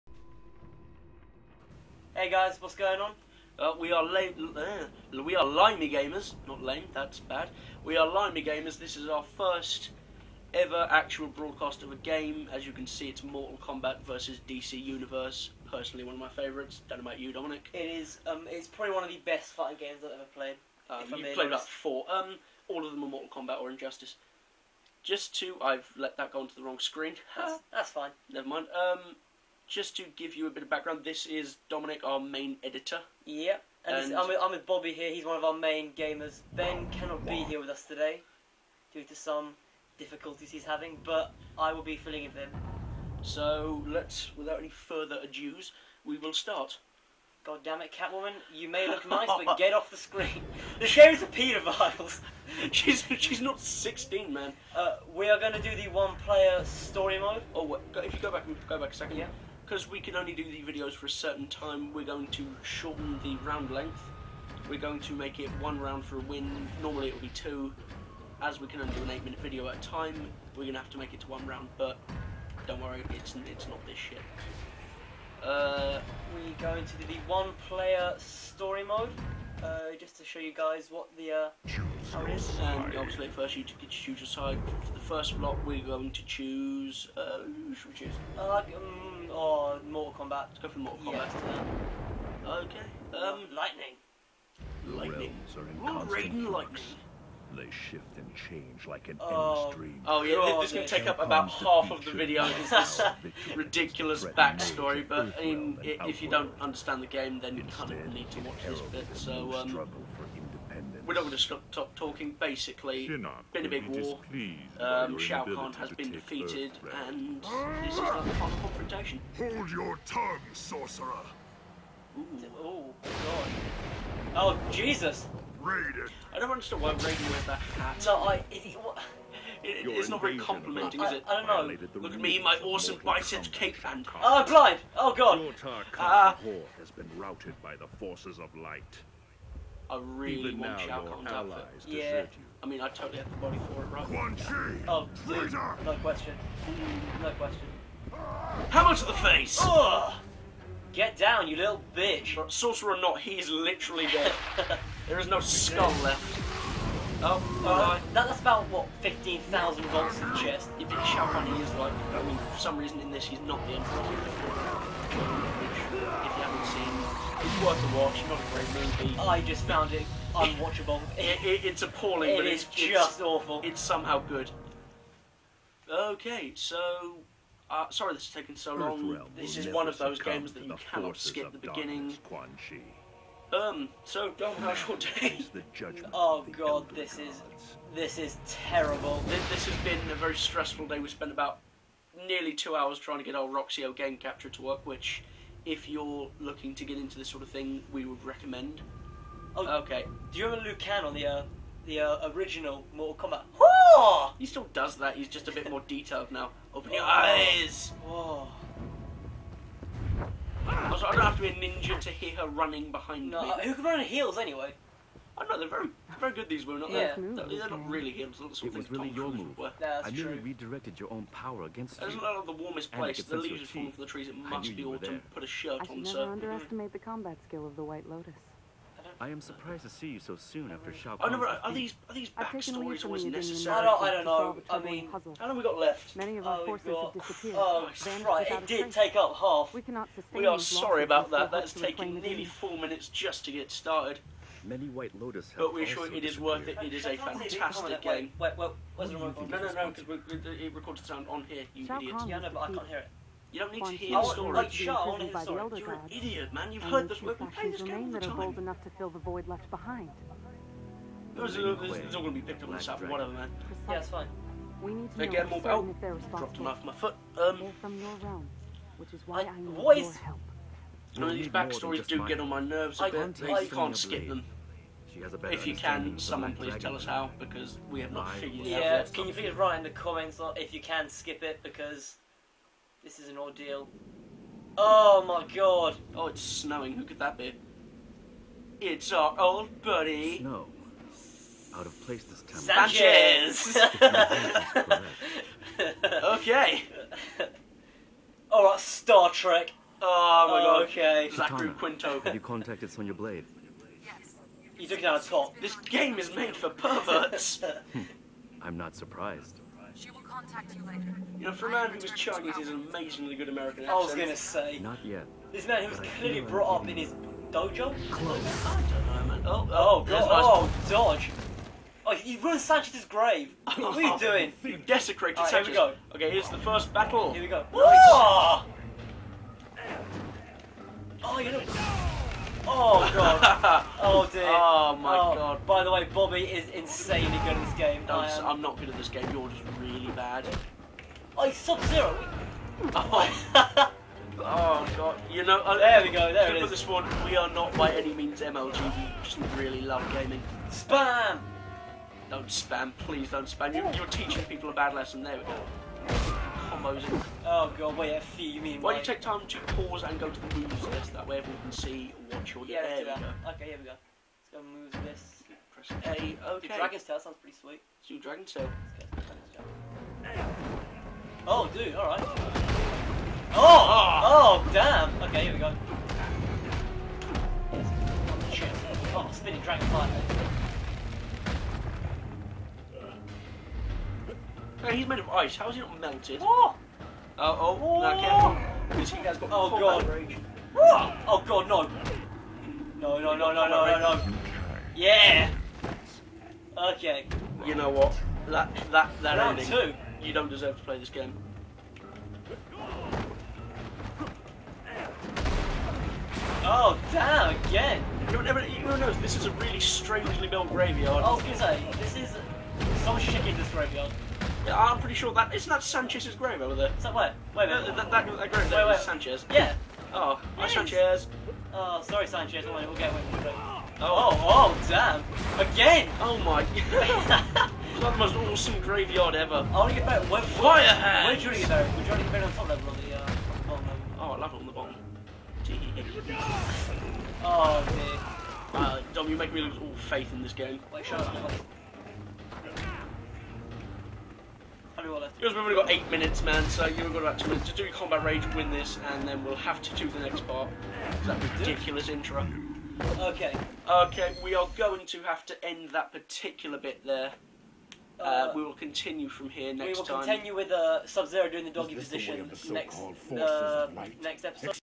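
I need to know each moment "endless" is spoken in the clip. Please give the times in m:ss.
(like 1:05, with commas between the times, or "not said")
1:39.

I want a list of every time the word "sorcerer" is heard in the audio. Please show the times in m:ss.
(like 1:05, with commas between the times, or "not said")
2:00, 2:32.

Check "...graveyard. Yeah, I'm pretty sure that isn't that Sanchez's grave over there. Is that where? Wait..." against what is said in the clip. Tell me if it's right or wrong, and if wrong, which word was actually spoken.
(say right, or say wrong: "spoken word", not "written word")
right.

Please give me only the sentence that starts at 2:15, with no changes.
Your uh, has been routed by the forces of light.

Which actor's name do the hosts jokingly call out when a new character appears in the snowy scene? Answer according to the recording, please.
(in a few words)
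Zachary Quinto.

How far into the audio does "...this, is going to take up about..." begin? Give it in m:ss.
1:40.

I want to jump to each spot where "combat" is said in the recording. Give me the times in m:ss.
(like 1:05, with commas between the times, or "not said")
3:46, 7:27.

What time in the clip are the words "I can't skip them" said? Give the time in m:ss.
4:33.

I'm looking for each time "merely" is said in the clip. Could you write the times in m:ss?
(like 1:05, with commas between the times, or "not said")
3:40.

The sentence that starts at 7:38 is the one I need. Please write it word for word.
Uh, uh, we will continue from here next time.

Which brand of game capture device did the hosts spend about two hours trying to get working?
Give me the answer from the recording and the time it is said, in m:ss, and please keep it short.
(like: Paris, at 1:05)
Roxio, at 3:13.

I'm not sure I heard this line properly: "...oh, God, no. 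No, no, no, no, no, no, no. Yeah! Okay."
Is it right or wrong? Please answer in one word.
right.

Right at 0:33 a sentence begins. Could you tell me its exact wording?
Yeah, and, and I'm, with, I'm, with, Bobby here.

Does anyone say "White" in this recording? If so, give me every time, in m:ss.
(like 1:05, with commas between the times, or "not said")
3:47, 4:04.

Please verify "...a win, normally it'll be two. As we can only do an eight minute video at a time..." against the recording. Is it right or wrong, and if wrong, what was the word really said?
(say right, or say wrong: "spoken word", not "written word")
right.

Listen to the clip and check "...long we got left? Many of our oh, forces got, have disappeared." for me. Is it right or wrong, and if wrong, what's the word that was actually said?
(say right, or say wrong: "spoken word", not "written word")
right.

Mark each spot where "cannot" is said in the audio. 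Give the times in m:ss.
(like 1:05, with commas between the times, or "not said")
0:36, 3:00, 3:59.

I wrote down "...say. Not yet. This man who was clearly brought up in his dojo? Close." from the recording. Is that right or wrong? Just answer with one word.
right.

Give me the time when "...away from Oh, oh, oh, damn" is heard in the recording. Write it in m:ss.
7:03.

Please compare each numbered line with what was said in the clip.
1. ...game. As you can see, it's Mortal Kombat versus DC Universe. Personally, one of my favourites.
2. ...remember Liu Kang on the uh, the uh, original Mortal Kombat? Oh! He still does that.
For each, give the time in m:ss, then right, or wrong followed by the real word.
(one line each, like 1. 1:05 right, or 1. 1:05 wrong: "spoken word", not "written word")
1. 0:11 right
2. 3:20 right.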